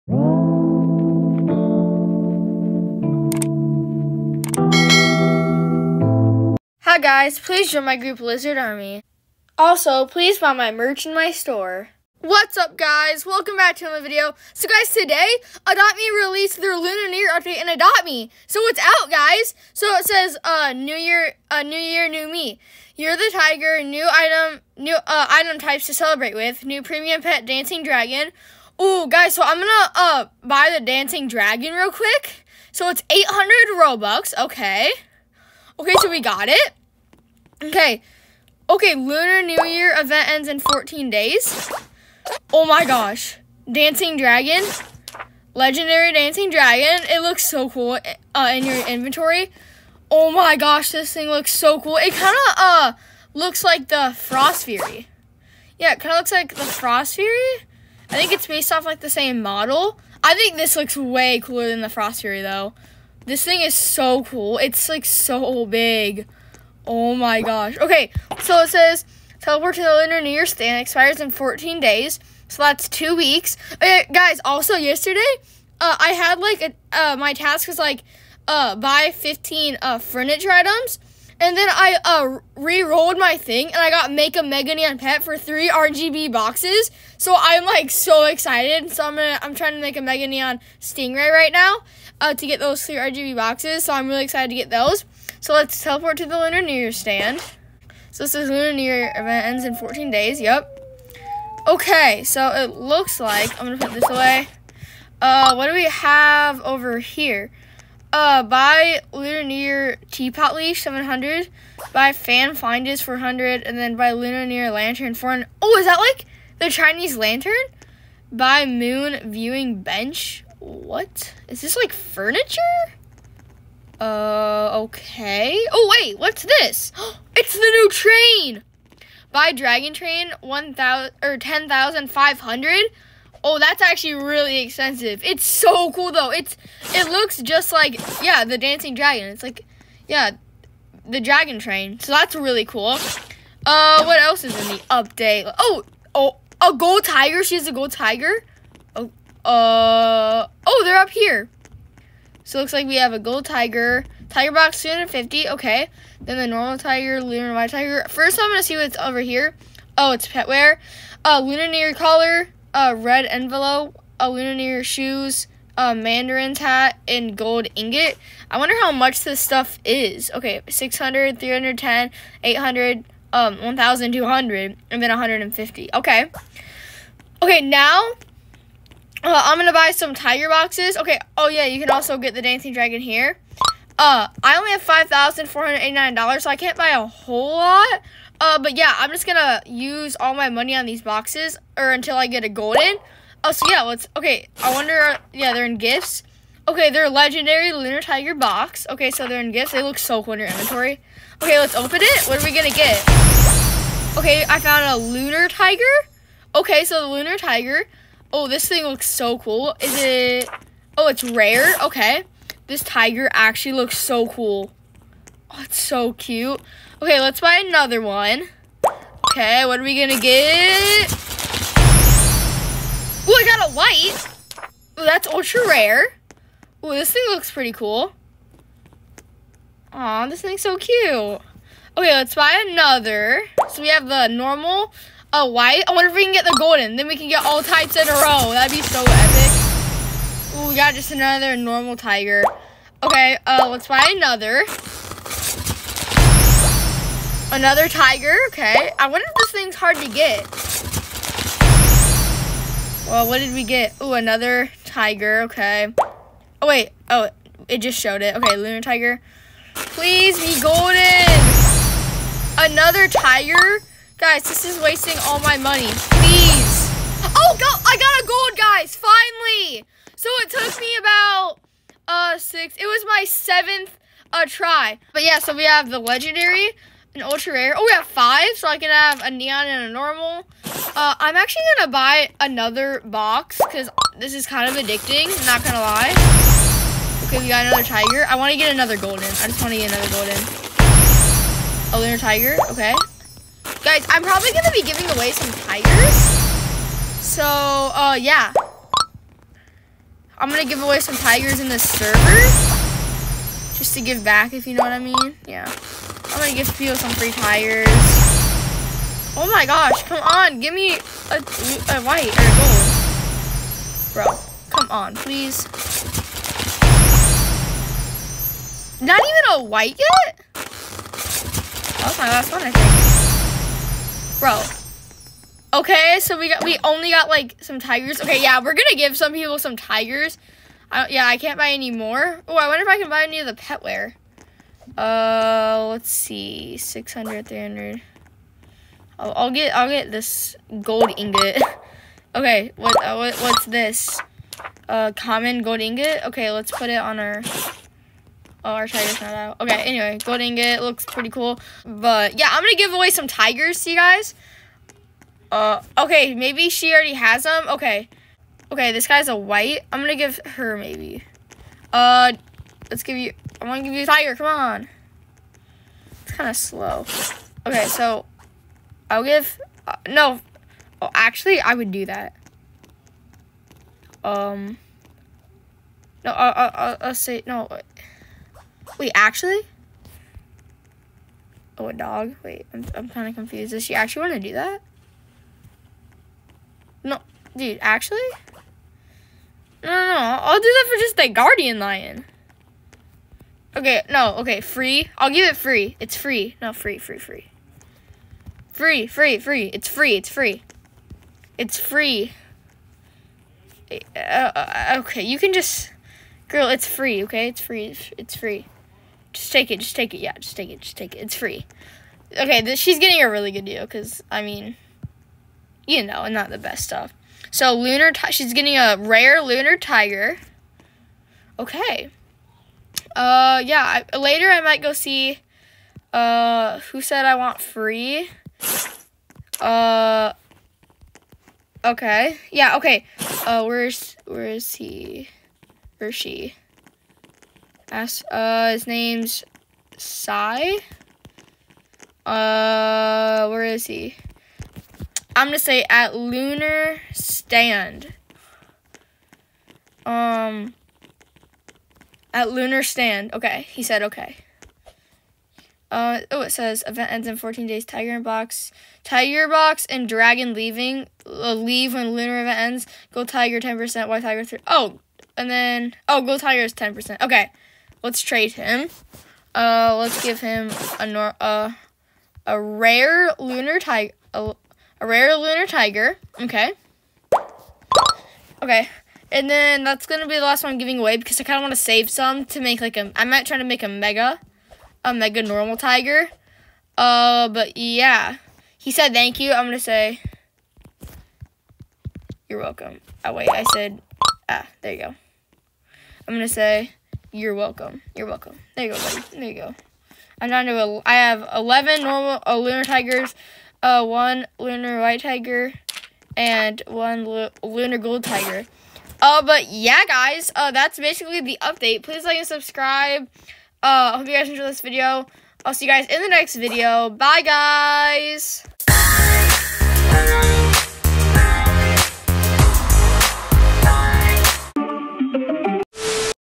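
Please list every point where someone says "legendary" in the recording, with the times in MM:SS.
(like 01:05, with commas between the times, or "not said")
00:45, 03:17, 04:35.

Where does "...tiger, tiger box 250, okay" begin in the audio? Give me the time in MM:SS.
02:33.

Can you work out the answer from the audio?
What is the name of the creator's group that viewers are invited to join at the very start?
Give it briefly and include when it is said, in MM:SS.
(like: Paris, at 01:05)
Lizard Army, at 00:08.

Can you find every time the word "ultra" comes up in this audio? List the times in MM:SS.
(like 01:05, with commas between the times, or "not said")
03:45, 04:37.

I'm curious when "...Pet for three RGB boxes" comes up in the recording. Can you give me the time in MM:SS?
01:24.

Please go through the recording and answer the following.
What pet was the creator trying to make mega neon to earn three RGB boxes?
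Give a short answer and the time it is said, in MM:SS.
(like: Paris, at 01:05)
Stingray, at 01:30.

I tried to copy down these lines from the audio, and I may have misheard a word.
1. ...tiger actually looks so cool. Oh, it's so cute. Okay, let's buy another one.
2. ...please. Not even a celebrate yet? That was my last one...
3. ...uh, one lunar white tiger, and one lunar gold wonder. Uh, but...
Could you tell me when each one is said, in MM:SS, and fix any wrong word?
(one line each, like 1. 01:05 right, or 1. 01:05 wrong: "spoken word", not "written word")
1. 03:32 right
2. 05:15 wrong: "white", not "celebrate"
3. 08:23 wrong: "tiger", not "wonder".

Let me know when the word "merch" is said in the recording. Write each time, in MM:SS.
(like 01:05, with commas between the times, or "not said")
00:10.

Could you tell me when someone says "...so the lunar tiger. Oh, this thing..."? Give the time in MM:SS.
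03:26.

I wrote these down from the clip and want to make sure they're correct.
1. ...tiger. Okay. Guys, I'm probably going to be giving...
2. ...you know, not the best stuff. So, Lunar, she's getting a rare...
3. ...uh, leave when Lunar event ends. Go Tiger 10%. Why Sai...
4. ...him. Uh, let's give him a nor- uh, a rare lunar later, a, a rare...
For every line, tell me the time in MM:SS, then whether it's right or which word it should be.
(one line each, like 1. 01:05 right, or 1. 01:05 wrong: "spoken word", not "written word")
1. 04:52 right
2. 06:55 right
3. 07:41 wrong: "Tiger", not "Sai"
4. 07:48 wrong: "tiger", not "later".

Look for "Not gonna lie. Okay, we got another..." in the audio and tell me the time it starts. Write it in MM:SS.
04:45.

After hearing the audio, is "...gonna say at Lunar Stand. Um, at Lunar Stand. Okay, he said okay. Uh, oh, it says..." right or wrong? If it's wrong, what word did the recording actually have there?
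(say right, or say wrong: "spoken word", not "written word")
right.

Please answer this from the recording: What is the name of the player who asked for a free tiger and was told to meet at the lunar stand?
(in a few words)
Sai.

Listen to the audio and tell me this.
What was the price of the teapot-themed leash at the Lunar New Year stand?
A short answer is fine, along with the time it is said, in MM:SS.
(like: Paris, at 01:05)
700, at 01:50.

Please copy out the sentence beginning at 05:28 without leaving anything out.
Okay, yeah, we're gonna give some people some tigers.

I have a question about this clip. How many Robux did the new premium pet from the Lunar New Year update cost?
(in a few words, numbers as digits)
800.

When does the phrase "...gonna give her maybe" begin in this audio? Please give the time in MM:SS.
06:00.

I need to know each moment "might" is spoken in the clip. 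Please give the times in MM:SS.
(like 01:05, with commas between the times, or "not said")
07:04, 08:03.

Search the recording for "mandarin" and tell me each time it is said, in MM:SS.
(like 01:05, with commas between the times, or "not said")
02:45.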